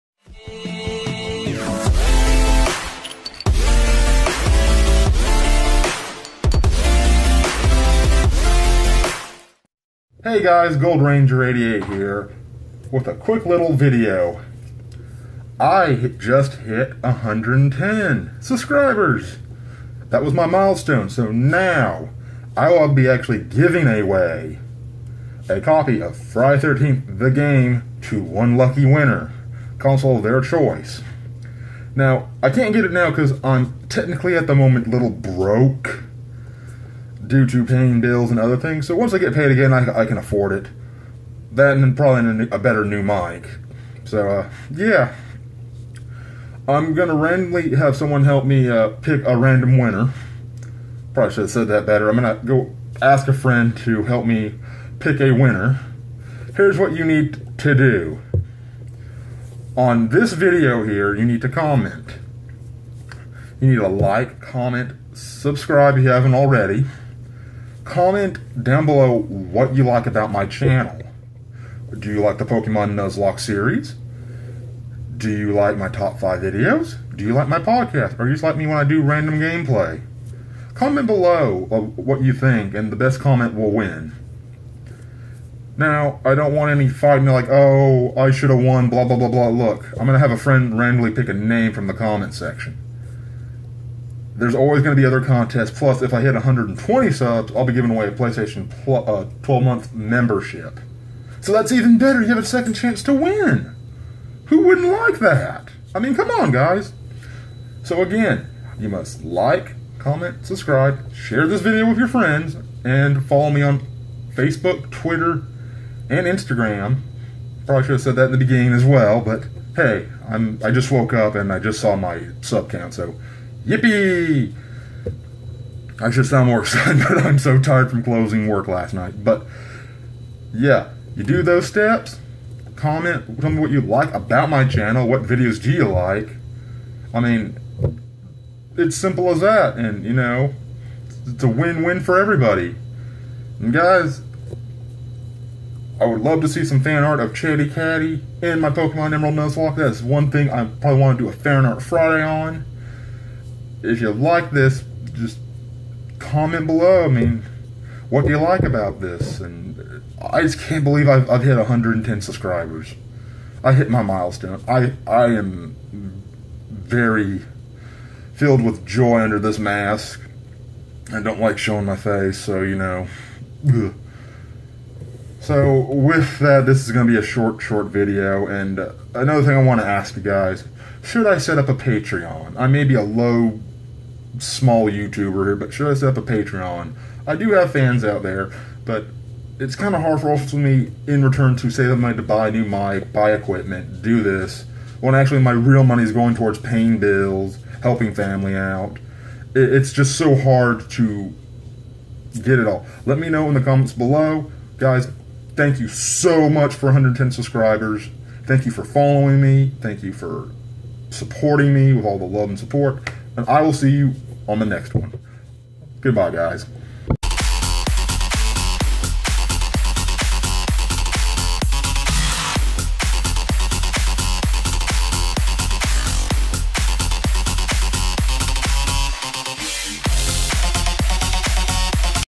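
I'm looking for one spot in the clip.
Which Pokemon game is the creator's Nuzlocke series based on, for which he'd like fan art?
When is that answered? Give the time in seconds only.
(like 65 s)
148 s.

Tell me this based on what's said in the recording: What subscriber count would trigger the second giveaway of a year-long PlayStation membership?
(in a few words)
120.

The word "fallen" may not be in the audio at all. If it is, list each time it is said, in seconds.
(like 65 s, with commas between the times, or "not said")
not said.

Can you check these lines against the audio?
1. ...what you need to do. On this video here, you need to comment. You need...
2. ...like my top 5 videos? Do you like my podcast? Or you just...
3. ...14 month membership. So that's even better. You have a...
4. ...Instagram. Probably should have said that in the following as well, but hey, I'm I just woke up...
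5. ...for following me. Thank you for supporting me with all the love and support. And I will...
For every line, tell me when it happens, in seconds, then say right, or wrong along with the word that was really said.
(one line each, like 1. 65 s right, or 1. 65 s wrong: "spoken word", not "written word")
1. 56 s right
2. 75 s right
3. 99 s wrong: "12", not "14"
4. 116 s wrong: "beginning", not "following"
5. 208 s right.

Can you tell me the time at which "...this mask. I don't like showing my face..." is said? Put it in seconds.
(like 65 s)
169 s.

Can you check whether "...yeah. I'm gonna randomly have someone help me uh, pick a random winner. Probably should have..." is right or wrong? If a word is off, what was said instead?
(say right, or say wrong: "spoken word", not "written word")
right.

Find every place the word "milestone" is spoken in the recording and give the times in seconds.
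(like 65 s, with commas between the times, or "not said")
20 s, 164 s.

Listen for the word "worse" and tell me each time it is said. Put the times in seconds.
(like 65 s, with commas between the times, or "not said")
not said.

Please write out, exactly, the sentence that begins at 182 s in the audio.
I may be a low small YouTuber here, but should I set up a Patreon?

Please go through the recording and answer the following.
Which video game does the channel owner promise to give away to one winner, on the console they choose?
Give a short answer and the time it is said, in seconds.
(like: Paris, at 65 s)
Friday 13th, at 26 s.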